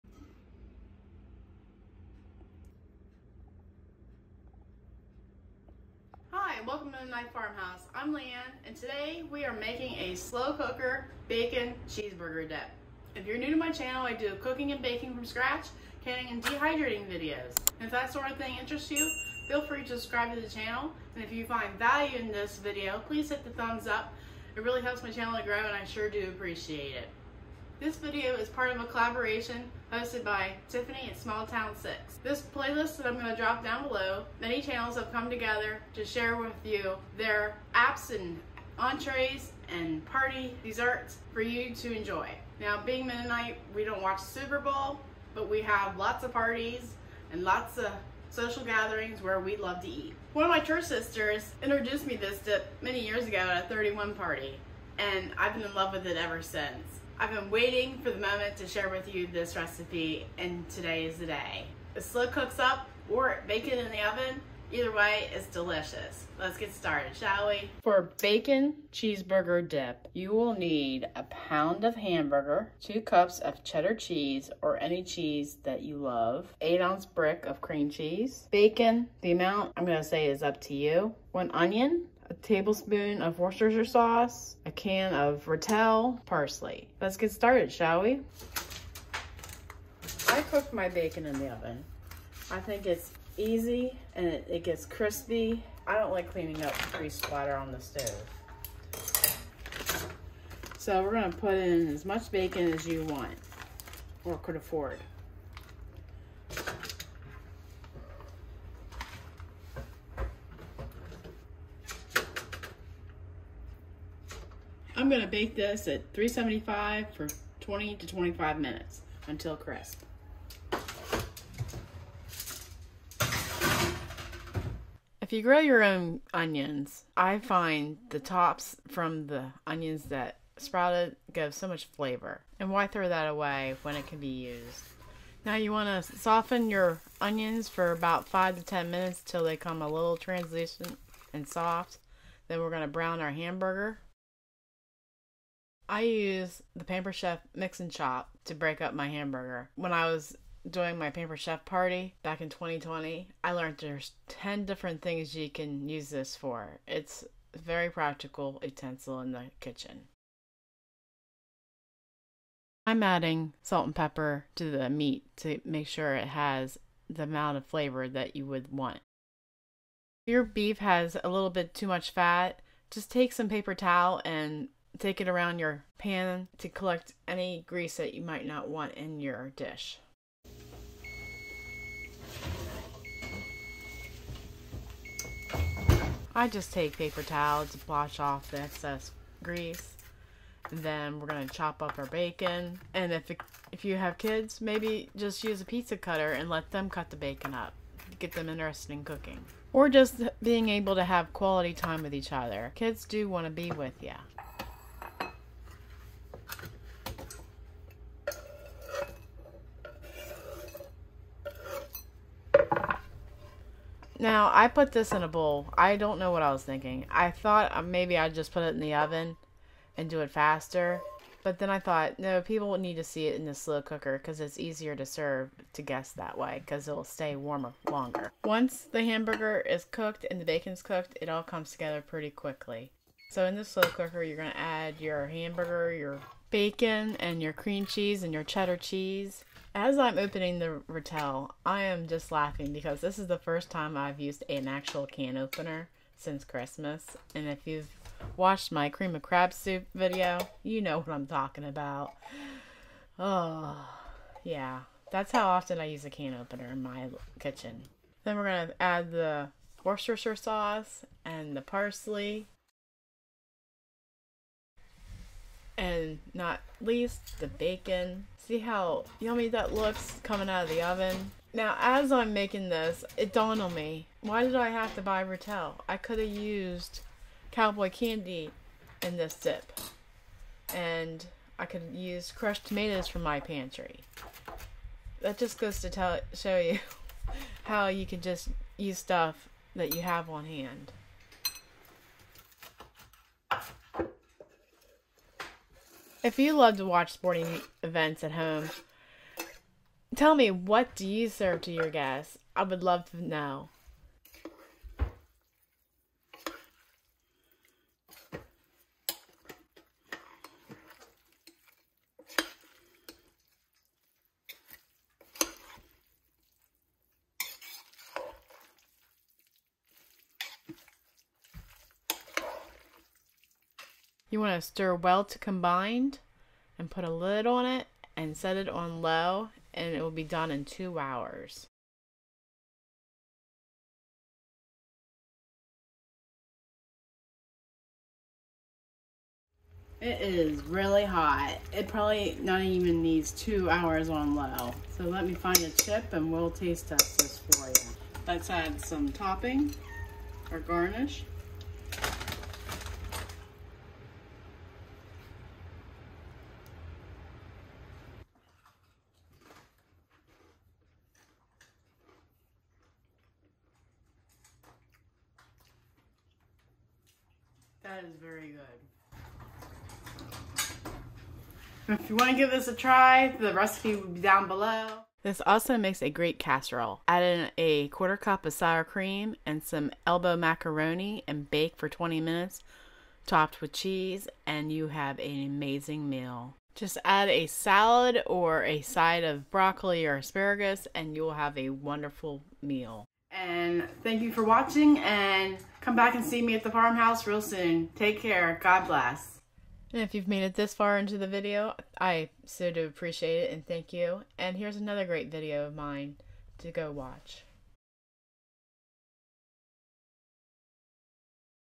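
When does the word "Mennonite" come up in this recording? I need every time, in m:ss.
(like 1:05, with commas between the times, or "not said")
0:06, 0:43.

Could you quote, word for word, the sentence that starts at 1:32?
I think it's easy and it, it gets crispy.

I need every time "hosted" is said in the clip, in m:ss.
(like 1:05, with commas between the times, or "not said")
0:29.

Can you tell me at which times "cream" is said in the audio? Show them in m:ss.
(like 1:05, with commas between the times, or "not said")
1:17, 3:57, 4:08, 6:18.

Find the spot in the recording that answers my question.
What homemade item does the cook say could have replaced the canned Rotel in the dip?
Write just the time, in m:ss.
4:37.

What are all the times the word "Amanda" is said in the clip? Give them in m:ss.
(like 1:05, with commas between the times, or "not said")
not said.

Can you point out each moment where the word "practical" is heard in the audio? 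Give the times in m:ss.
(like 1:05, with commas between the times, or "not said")
2:37.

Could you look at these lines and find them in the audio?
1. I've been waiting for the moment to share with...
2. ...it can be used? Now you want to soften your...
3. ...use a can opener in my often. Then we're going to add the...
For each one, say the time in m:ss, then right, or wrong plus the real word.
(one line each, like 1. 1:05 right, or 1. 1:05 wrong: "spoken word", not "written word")
1. 0:57 right
2. 2:13 right
3. 4:15 wrong: "kitchen", not "often".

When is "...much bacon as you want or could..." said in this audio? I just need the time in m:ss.
1:42.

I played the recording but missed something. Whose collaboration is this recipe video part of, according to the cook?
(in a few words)
Tiffany.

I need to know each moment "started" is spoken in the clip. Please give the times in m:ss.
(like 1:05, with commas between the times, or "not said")
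1:06, 1:27.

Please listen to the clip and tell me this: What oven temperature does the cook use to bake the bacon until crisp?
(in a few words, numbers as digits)
375.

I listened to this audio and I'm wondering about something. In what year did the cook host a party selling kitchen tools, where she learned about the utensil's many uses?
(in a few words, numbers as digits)
2020.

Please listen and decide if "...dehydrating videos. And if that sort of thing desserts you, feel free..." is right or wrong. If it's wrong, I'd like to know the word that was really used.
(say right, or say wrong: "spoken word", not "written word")
wrong: "interests", not "desserts".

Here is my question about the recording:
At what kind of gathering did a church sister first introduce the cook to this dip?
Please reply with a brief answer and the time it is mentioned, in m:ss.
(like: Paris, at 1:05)
A 31 party, at 0:53.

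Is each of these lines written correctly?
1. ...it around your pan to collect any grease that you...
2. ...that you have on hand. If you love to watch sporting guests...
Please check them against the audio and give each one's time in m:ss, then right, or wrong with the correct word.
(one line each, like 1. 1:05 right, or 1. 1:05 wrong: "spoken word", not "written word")
1. 2:55 right
2. 4:49 wrong: "events", not "guests".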